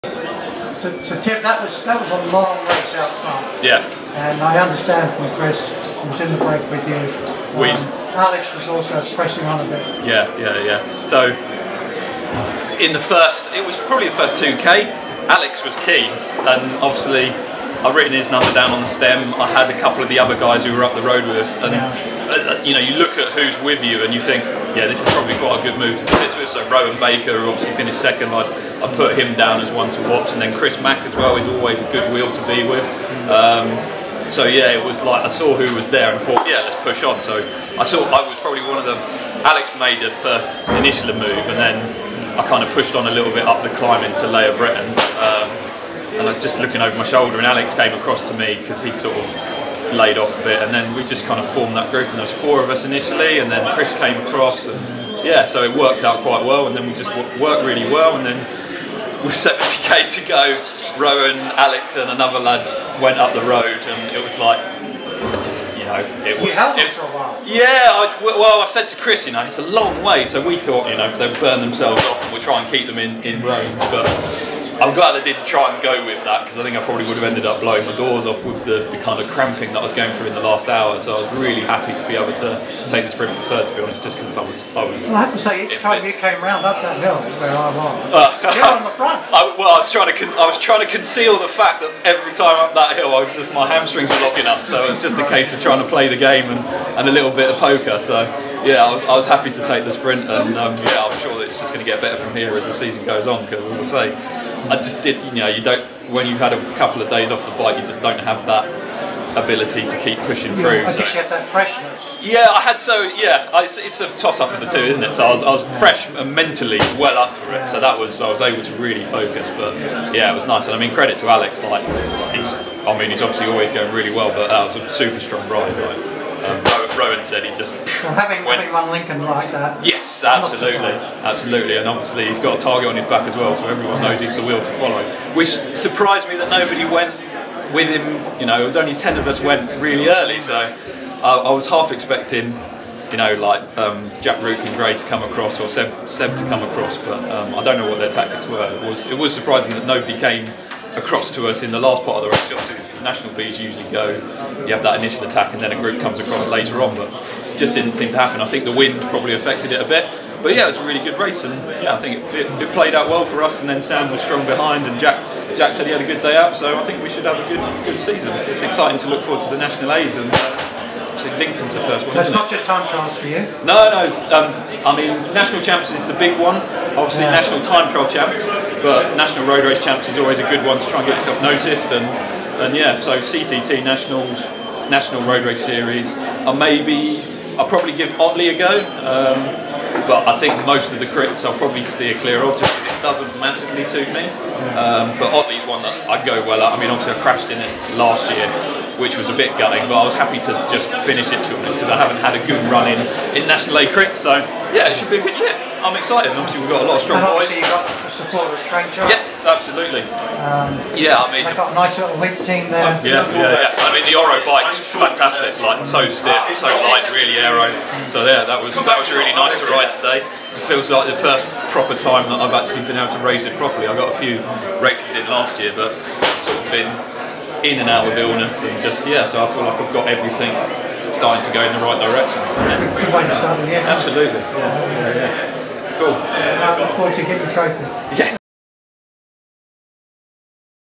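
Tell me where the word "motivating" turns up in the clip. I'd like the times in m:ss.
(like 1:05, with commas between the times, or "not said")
not said.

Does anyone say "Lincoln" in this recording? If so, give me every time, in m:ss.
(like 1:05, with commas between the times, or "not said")
2:08, 2:51.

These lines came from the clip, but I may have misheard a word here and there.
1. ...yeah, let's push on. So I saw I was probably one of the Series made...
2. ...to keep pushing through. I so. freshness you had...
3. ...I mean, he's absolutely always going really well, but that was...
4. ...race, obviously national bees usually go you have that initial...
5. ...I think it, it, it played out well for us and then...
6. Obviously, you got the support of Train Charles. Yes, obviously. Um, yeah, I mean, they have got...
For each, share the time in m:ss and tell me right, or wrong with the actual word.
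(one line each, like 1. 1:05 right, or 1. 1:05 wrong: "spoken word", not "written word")
1. 0:36 wrong: "Alex", not "Series"
2. 1:49 wrong: "guess", not "freshness"
3. 2:02 wrong: "obviously", not "absolutely"
4. 2:32 right
5. 2:41 right
6. 3:27 wrong: "absolutely", not "obviously".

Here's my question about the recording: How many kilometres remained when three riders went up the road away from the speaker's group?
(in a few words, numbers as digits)
70.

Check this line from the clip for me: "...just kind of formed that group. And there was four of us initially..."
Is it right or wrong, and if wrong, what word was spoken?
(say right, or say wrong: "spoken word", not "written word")
right.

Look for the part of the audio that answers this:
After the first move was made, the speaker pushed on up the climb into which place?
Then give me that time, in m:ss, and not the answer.
0:44.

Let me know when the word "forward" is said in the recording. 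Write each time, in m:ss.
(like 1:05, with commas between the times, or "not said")
2:49, 3:56.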